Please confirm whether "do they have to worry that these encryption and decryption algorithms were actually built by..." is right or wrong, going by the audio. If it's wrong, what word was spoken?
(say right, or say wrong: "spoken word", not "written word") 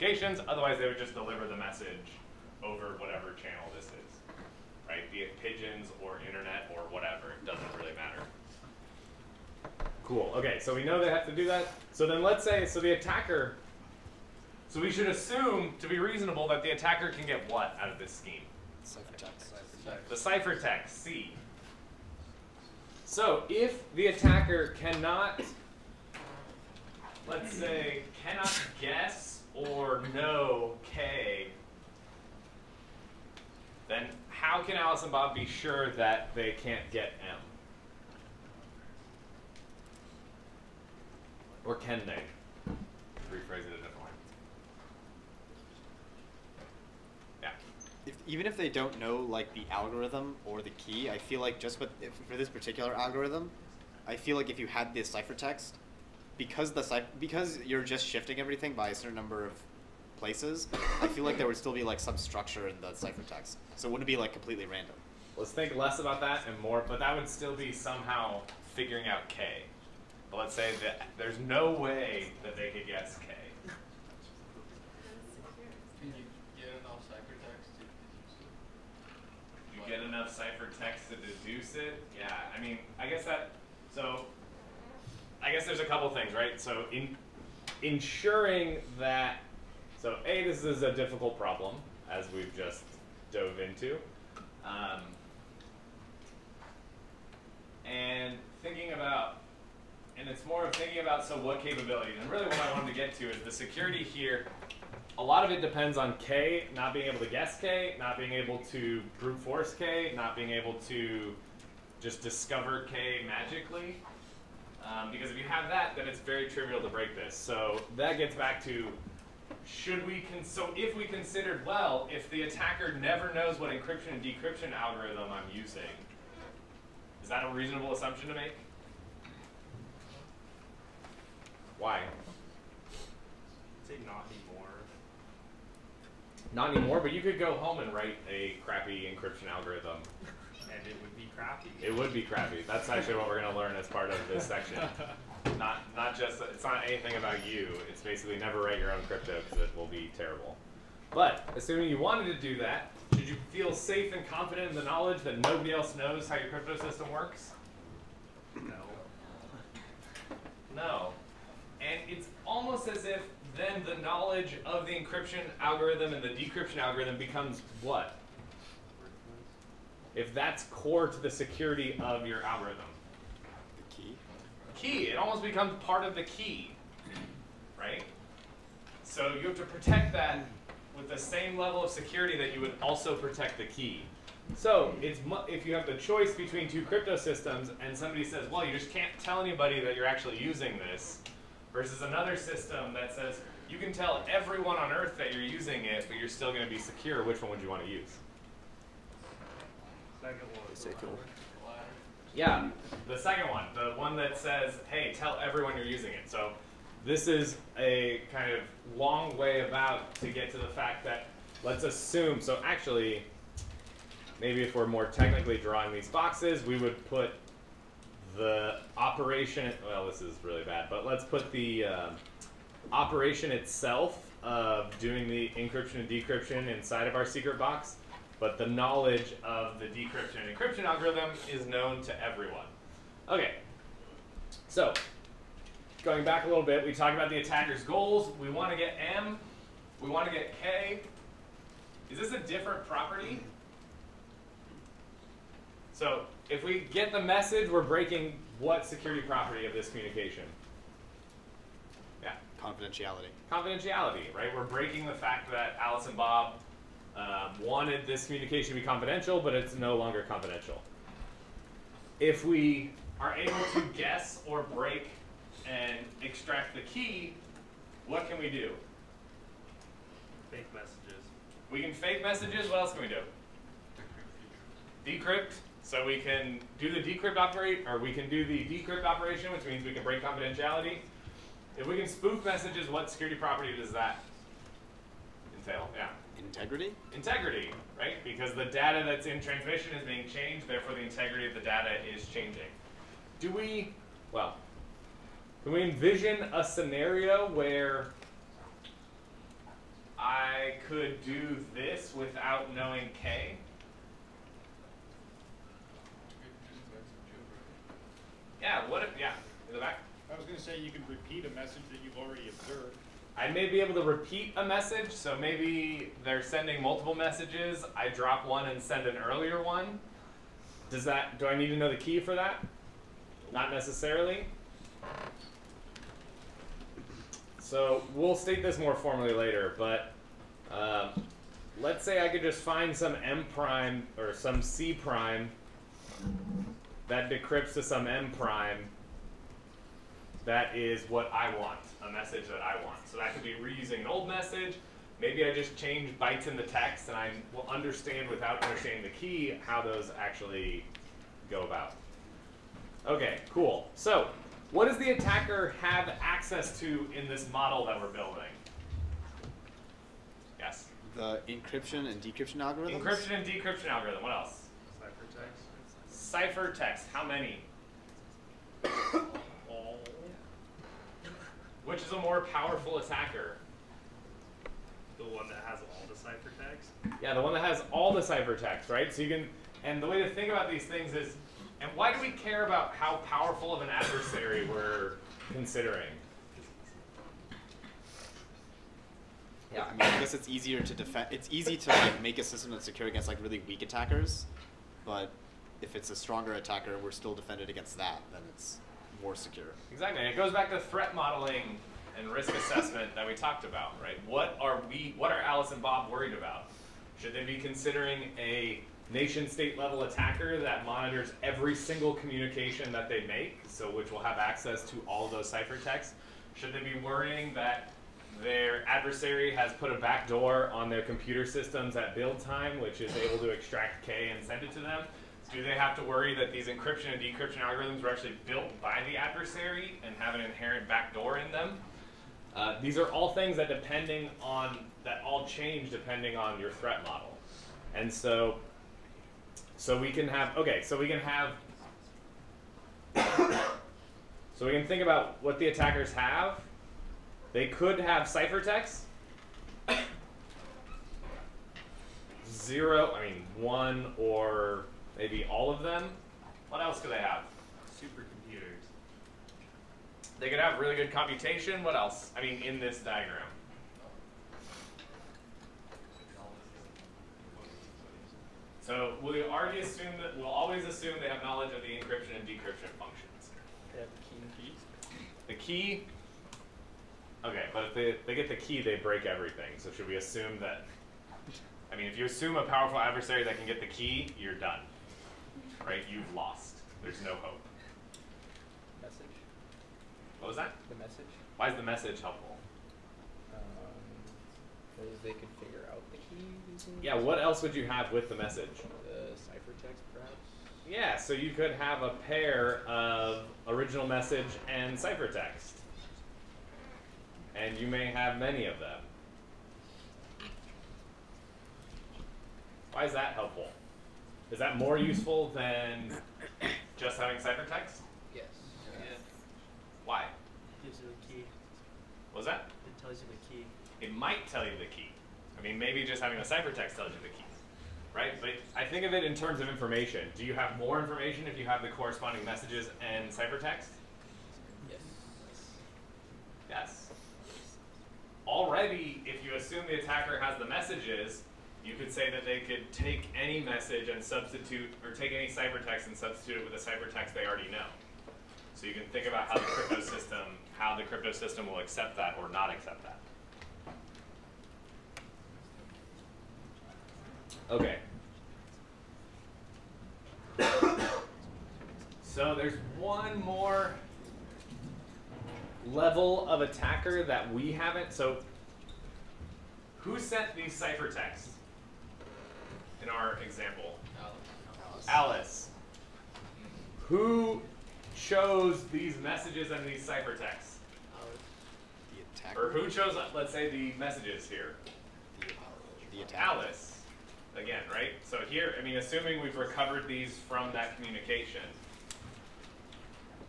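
right.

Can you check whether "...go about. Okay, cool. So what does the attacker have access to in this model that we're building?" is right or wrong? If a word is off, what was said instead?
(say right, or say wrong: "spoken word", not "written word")
right.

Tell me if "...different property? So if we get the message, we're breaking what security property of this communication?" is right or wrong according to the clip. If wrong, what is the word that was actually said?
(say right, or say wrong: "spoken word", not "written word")
right.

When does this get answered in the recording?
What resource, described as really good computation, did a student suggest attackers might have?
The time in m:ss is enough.
7:38.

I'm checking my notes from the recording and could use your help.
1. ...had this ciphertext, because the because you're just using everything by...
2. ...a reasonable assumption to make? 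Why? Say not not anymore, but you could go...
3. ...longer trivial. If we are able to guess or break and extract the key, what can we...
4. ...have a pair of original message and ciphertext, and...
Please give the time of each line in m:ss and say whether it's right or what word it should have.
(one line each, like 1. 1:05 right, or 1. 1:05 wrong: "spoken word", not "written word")
1. 0:54 wrong: "shifting", not "using"
2. 2:07 right
3. 4:19 wrong: "confidential", not "trivial"
4. 8:21 right.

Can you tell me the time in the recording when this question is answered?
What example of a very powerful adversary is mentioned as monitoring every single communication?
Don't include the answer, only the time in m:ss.
6:49.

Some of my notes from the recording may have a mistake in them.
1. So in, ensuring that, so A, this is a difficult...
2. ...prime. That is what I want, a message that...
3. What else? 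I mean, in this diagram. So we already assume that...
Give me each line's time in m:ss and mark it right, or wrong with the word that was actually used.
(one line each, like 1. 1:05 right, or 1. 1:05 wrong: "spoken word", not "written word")
1. 1:26 right
2. 5:38 right
3. 7:41 right.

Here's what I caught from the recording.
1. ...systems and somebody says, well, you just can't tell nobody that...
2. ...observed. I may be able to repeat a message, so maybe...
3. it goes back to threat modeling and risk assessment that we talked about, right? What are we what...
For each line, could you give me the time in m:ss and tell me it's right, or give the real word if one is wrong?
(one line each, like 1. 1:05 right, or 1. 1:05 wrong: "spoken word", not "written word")
1. 3:07 wrong: "anybody", not "nobody"
2. 5:12 right
3. 6:40 right.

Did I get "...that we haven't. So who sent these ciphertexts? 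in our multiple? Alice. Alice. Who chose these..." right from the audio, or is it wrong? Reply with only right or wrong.
wrong.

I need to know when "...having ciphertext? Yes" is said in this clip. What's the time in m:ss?
8:37.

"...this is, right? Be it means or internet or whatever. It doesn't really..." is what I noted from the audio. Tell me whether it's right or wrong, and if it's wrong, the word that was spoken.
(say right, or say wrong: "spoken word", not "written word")
wrong: "pigeons", not "means".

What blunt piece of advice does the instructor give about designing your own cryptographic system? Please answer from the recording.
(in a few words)
never write your own crypto.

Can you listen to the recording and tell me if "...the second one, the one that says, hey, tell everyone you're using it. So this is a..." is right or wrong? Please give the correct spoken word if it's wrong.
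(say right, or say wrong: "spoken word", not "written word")
right.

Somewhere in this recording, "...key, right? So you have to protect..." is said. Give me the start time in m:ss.
2:56.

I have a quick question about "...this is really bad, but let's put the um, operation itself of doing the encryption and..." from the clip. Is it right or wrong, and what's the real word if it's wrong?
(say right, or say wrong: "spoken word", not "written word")
right.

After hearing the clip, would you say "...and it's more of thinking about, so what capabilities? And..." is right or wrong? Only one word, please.
right.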